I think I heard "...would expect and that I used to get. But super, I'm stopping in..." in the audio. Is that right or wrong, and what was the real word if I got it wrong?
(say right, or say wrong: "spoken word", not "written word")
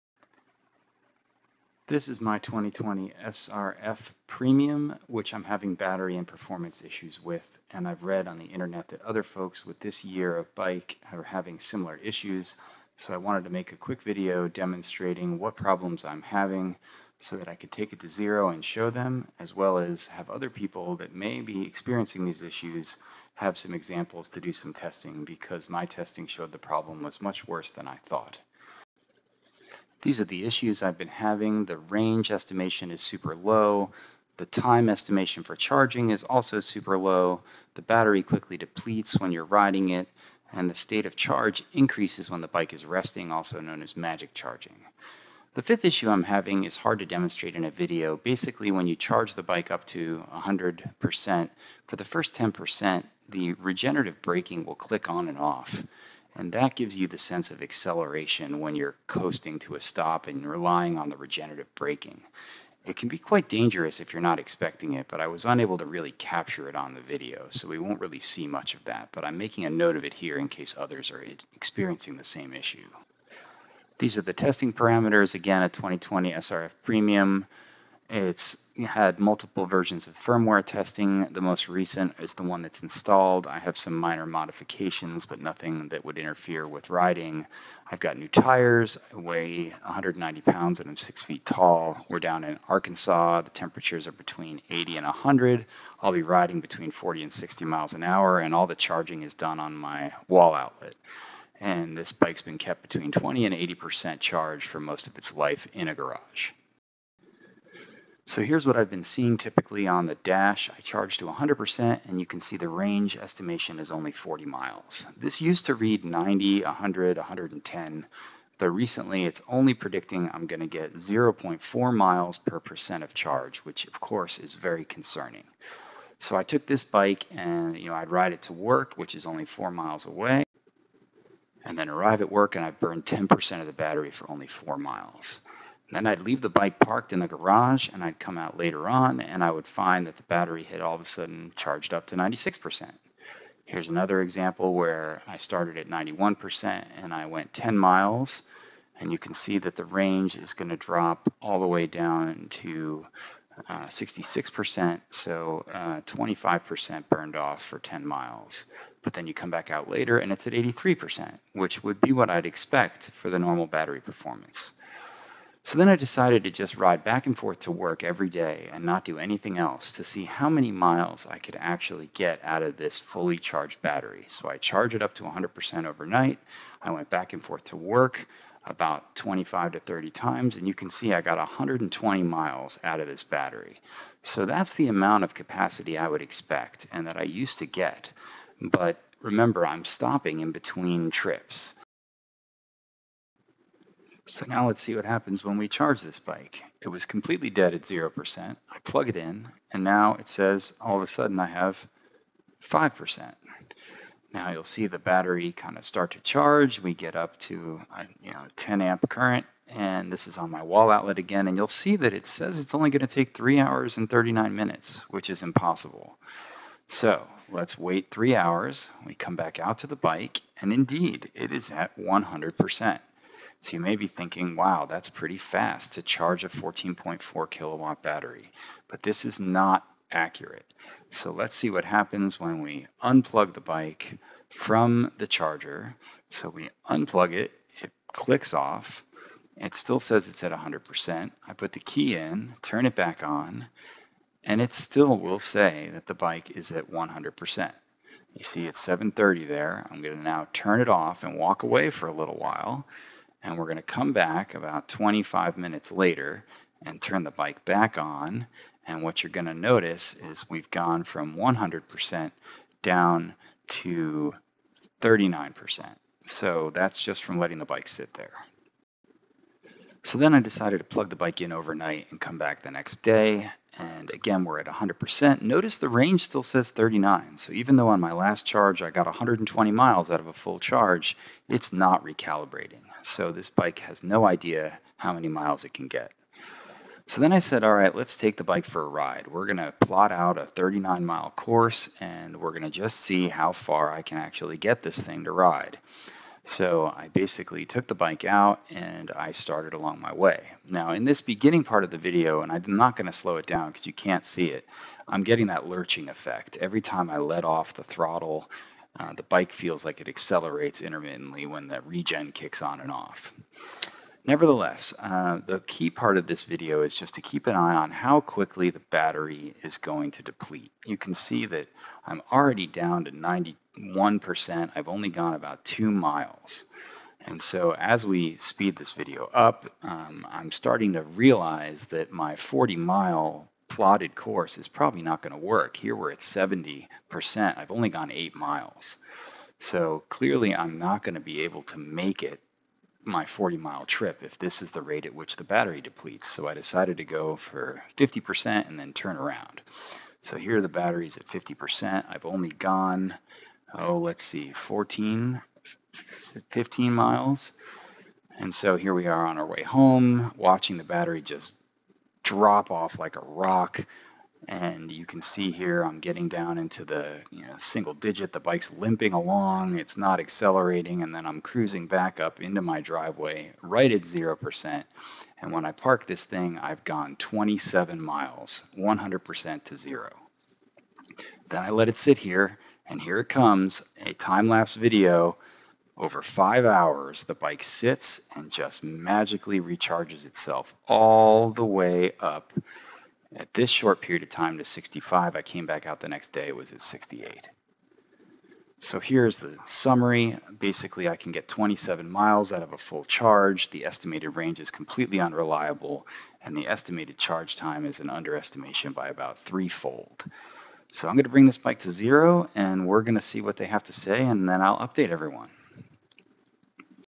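wrong: "remember", not "super".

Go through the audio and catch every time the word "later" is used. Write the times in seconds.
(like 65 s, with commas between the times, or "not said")
138 s, 159 s, 255 s.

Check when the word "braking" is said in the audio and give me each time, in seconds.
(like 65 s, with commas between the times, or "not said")
54 s, 61 s.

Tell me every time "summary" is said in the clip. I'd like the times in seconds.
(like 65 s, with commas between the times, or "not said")
399 s.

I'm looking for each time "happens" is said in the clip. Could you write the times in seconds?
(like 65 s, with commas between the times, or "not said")
195 s, 231 s.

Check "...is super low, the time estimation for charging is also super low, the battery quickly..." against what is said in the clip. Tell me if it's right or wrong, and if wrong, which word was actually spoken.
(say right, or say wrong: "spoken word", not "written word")
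right.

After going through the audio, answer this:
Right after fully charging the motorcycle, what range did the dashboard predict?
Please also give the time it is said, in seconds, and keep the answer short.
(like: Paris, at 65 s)
40 miles, at 114 s.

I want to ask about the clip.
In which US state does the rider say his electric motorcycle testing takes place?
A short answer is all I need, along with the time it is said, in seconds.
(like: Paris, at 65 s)
Arkansas, at 92 s.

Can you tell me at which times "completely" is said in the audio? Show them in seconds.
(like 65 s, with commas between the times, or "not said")
197 s, 404 s.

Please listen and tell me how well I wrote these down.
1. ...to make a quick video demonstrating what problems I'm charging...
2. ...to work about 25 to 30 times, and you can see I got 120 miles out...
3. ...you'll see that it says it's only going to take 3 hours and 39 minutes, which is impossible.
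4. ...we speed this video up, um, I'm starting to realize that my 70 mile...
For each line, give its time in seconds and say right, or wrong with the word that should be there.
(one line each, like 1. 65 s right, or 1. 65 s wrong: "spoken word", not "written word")
1. 13 s wrong: "having", not "charging"
2. 177 s right
3. 211 s right
4. 328 s wrong: "40", not "70".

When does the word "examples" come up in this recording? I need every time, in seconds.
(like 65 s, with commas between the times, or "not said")
23 s, 144 s.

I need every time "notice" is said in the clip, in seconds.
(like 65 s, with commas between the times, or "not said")
259 s, 275 s.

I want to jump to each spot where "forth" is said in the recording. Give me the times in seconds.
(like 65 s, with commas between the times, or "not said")
167 s, 177 s.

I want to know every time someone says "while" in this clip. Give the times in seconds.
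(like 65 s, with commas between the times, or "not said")
252 s.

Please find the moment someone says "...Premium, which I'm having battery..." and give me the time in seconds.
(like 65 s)
4 s.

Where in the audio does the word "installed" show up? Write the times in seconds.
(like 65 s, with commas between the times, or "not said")
82 s.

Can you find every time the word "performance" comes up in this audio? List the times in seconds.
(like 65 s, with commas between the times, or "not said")
6 s, 163 s.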